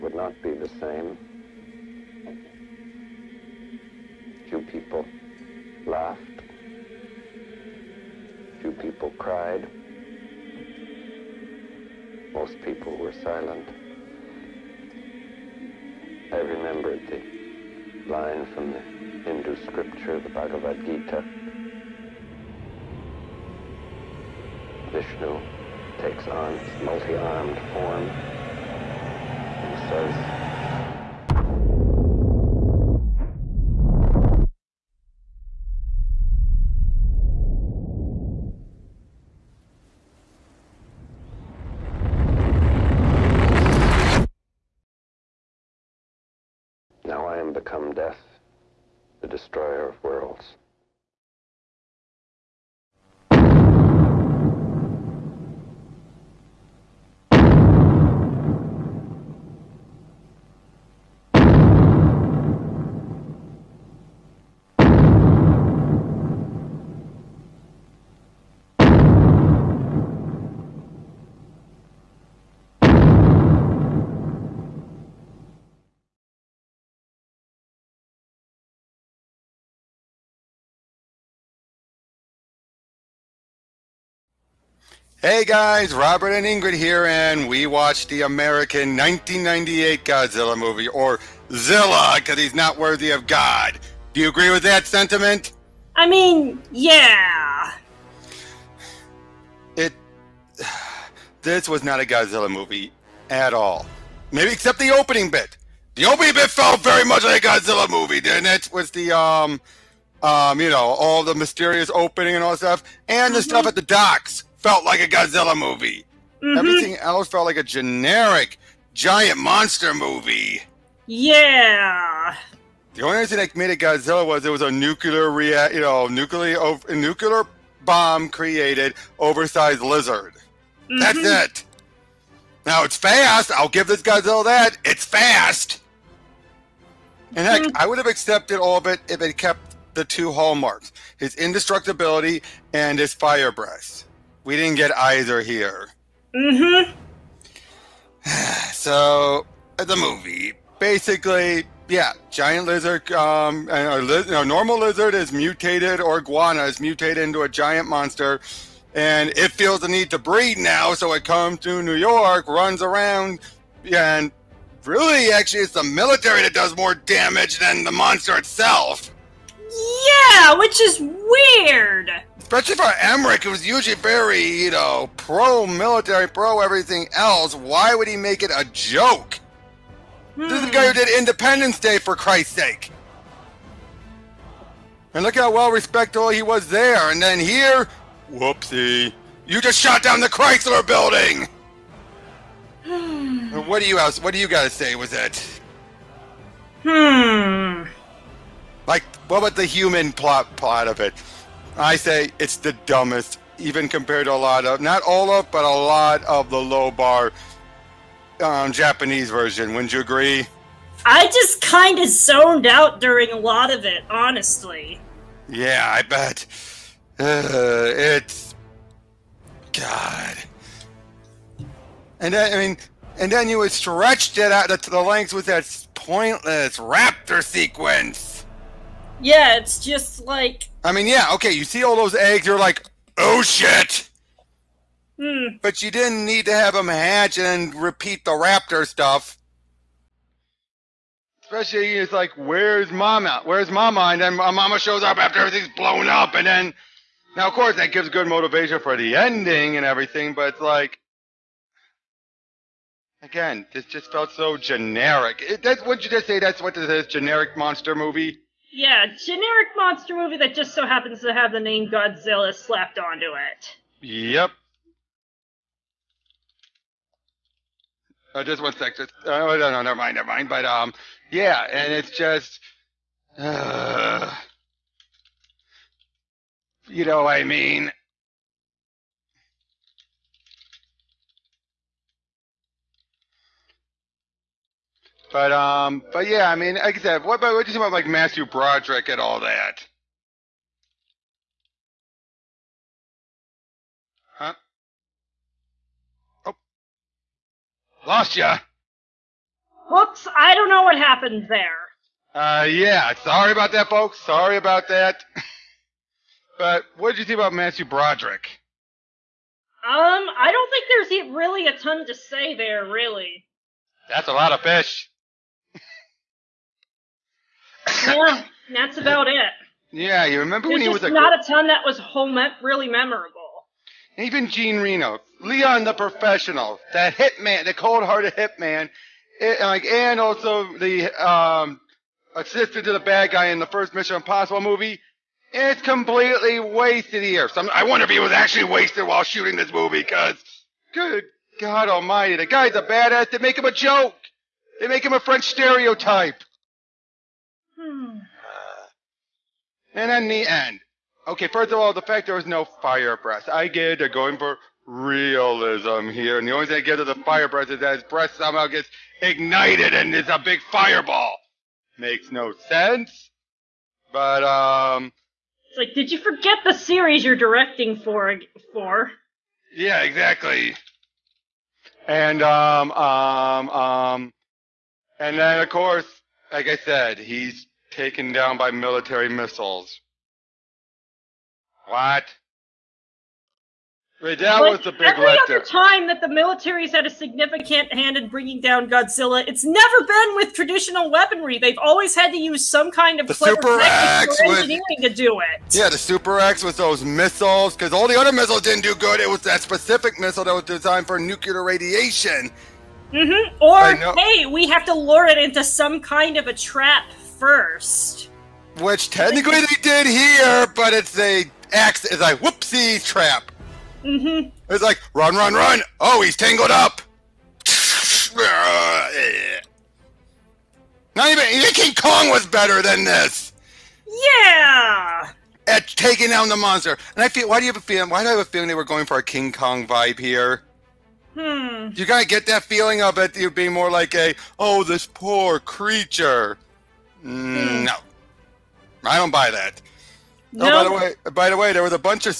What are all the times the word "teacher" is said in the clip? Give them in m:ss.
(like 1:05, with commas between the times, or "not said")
not said.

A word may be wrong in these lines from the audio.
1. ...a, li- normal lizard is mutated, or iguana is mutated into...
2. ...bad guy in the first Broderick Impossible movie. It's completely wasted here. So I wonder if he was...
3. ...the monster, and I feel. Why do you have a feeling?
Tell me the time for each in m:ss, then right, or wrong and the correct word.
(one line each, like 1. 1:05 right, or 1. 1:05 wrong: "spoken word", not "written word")
1. 2:33 right
2. 5:32 wrong: "Mission", not "Broderick"
3. 7:06 right.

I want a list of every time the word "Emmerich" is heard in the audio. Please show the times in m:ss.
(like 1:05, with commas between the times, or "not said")
2:53.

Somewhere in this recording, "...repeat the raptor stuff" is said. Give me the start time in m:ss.
3:57.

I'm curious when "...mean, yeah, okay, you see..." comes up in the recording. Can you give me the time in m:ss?
3:50.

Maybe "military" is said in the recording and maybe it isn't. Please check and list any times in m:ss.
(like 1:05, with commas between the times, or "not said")
2:45, 2:55, 6:18, 6:26.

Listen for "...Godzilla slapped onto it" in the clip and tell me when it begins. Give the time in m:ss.
4:21.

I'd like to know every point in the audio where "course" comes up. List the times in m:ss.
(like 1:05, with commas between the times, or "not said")
4:07, 6:15.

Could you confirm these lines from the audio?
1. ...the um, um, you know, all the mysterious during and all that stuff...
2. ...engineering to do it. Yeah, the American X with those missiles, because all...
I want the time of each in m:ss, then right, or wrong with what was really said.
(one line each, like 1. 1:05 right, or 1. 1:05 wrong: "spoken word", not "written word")
1. 1:48 wrong: "opening", not "during"
2. 6:34 wrong: "Super", not "American".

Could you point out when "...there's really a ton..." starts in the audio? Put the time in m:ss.
5:11.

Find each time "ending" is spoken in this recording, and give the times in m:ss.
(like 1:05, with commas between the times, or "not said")
4:09.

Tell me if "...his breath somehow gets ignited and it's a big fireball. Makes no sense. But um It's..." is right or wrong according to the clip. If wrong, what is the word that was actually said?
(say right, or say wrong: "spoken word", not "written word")
right.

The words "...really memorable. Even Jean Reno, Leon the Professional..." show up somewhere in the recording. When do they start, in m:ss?
5:22.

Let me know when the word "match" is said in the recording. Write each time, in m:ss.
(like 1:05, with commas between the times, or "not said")
not said.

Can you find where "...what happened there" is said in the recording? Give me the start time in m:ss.
5:00.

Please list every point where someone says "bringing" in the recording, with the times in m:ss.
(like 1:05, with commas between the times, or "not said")
6:28.